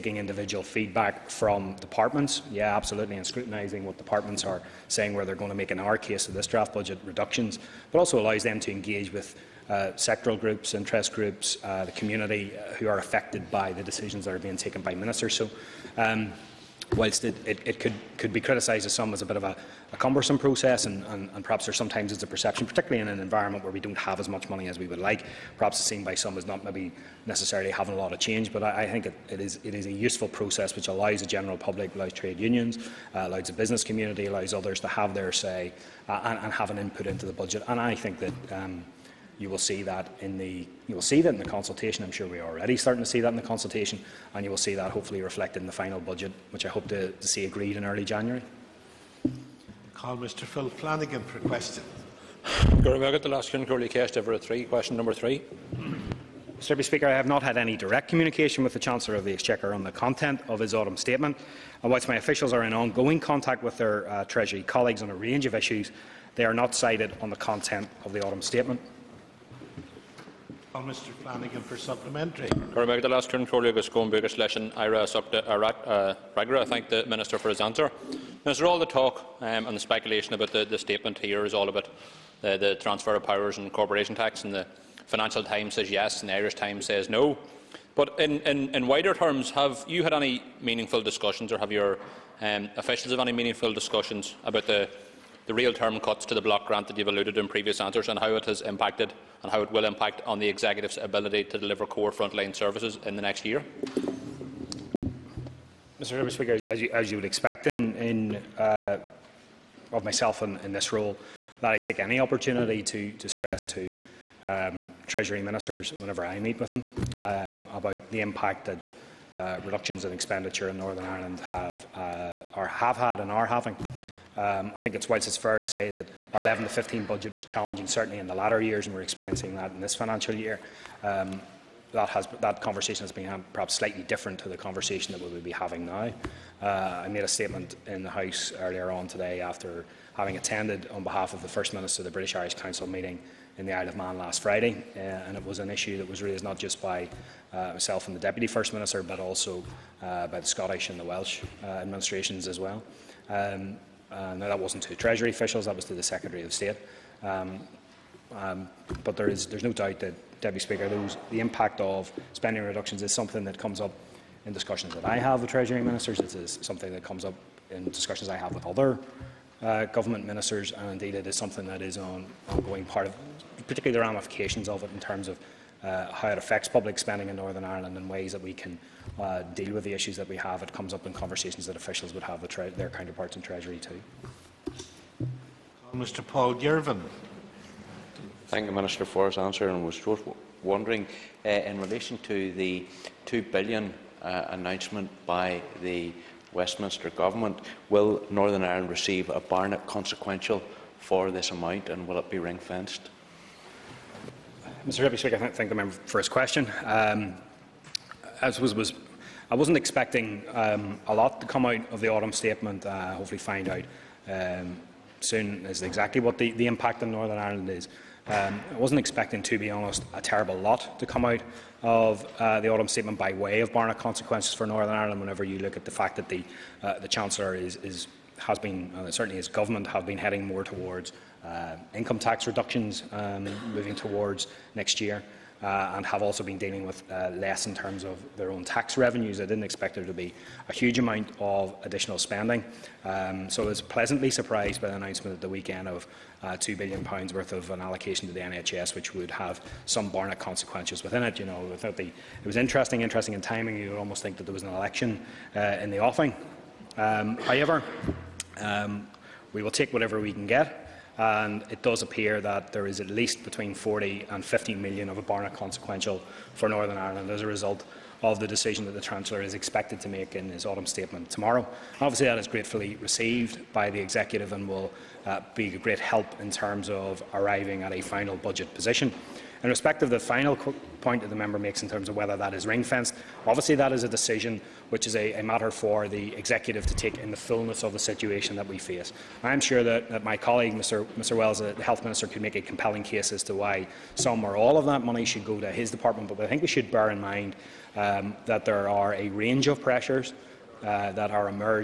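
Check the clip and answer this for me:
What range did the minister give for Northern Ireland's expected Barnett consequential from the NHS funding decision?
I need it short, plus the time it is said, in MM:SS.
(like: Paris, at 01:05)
40 to 50 million, at 04:23.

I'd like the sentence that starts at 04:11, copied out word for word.
You know, without the, it was interesting, interesting in timing.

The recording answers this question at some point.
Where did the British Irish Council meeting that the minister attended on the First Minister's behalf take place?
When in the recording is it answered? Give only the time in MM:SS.
02:23.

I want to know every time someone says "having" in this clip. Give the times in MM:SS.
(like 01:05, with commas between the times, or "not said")
00:27, 02:03, 02:15, 02:20.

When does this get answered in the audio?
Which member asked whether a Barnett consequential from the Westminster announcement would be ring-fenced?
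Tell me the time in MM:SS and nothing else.
03:06.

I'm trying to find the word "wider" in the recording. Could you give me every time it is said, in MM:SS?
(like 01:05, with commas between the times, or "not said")
01:28.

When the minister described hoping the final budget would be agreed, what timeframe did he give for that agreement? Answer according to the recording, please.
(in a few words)
early January.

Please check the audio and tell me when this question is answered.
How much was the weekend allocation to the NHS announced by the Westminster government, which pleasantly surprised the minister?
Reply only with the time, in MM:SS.
04:06.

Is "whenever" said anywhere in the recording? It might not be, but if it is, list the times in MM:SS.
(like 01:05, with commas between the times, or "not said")
01:55, 03:45.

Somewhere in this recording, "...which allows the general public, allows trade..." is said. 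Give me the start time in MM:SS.
00:30.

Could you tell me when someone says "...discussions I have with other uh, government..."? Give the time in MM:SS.
02:47.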